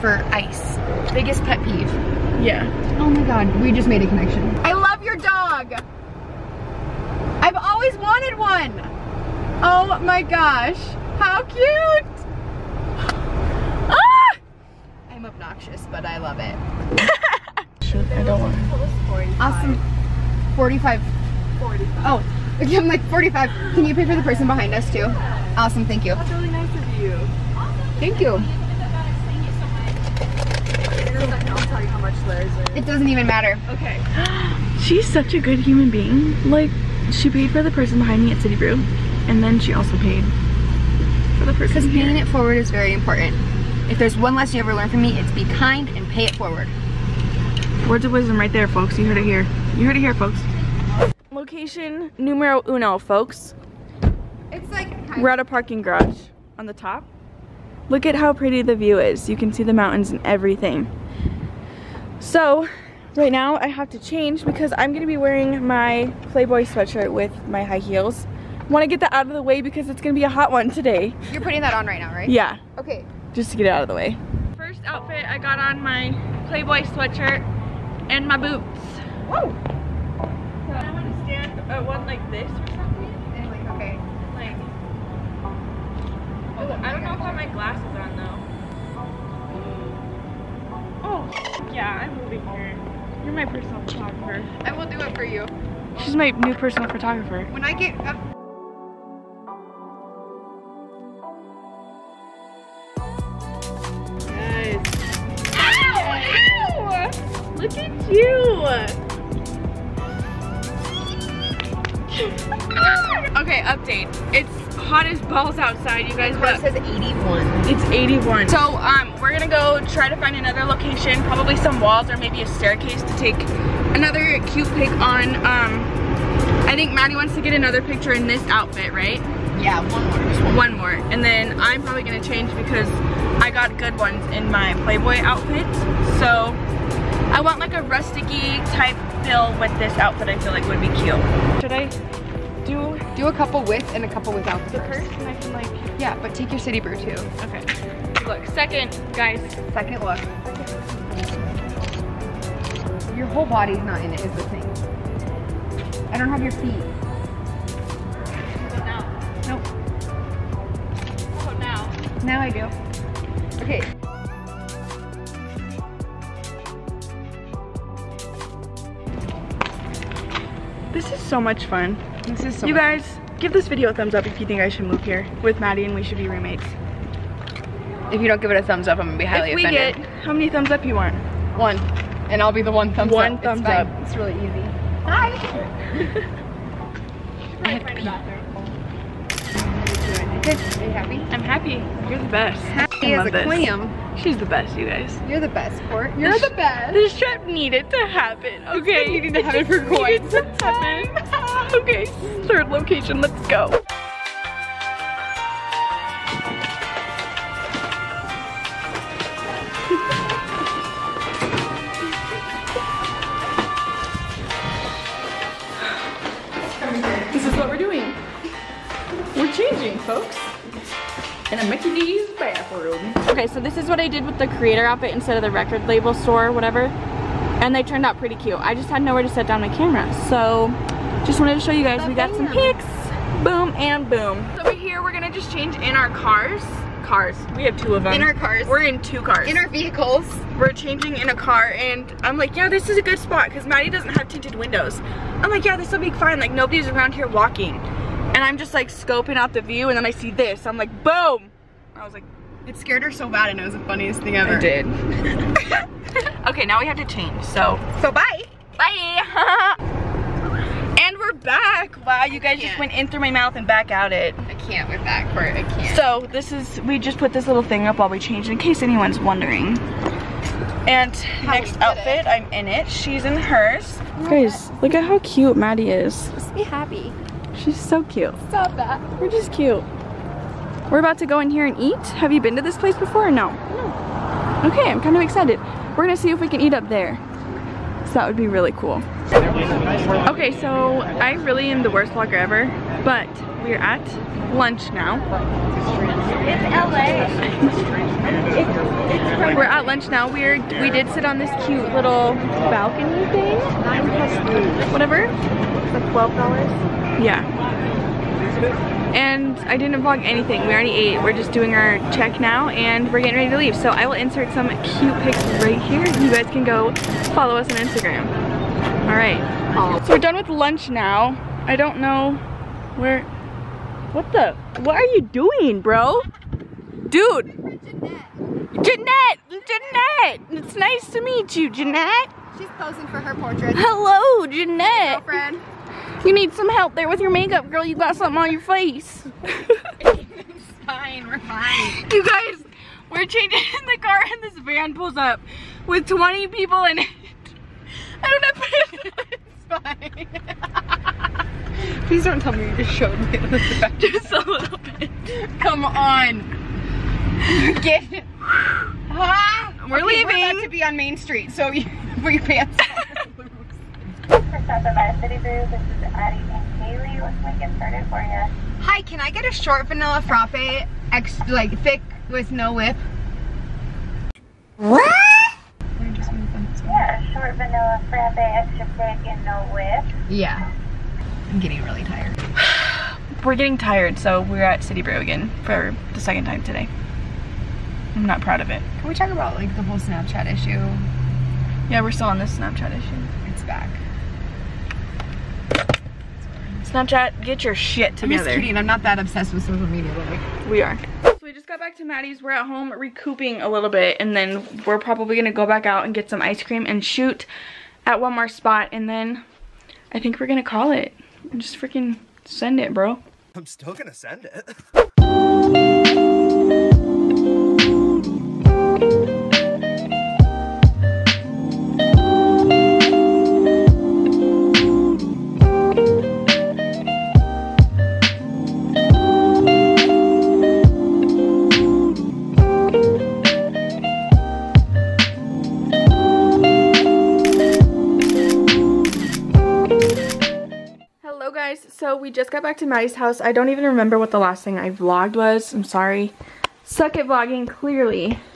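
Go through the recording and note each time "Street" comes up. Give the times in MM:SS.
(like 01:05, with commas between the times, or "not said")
06:01.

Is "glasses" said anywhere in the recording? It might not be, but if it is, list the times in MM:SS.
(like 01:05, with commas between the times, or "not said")
01:27.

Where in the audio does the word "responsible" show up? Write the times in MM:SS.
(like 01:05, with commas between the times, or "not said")
not said.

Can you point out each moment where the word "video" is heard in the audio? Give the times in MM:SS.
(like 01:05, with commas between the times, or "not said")
02:53.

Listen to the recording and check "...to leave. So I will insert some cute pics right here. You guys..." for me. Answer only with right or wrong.
right.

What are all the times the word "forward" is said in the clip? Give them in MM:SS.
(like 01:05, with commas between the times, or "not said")
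00:42, 00:46.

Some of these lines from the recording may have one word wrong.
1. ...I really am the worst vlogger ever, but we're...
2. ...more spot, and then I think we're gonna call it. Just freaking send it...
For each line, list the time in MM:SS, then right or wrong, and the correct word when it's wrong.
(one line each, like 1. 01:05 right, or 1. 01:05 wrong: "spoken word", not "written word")
1. 04:51 right
2. 06:48 right.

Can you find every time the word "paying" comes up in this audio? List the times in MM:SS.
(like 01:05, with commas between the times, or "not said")
00:41.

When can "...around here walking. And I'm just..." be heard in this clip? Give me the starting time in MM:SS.
04:06.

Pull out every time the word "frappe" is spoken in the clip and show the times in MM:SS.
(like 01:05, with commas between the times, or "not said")
06:10, 06:18.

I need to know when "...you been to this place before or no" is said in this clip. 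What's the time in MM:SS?
04:42.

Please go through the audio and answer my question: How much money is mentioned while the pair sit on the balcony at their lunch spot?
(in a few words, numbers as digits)
12 dollars.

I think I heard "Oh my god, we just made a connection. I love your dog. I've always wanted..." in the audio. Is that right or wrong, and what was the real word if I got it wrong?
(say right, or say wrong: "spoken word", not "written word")
right.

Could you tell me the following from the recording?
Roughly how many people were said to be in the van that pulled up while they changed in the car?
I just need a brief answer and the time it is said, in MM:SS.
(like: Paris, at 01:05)
20, at 05:46.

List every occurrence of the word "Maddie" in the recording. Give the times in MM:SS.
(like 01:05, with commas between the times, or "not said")
02:06, 02:55, 04:03, 04:35, 06:42, 07:22.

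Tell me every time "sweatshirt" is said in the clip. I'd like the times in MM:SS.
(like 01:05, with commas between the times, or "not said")
01:06, 01:16.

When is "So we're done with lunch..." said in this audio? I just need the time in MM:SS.
05:20.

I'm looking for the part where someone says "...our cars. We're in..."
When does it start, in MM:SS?
03:58.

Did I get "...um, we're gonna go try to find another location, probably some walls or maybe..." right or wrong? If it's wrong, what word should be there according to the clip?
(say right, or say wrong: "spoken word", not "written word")
right.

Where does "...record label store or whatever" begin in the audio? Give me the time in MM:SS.
03:45.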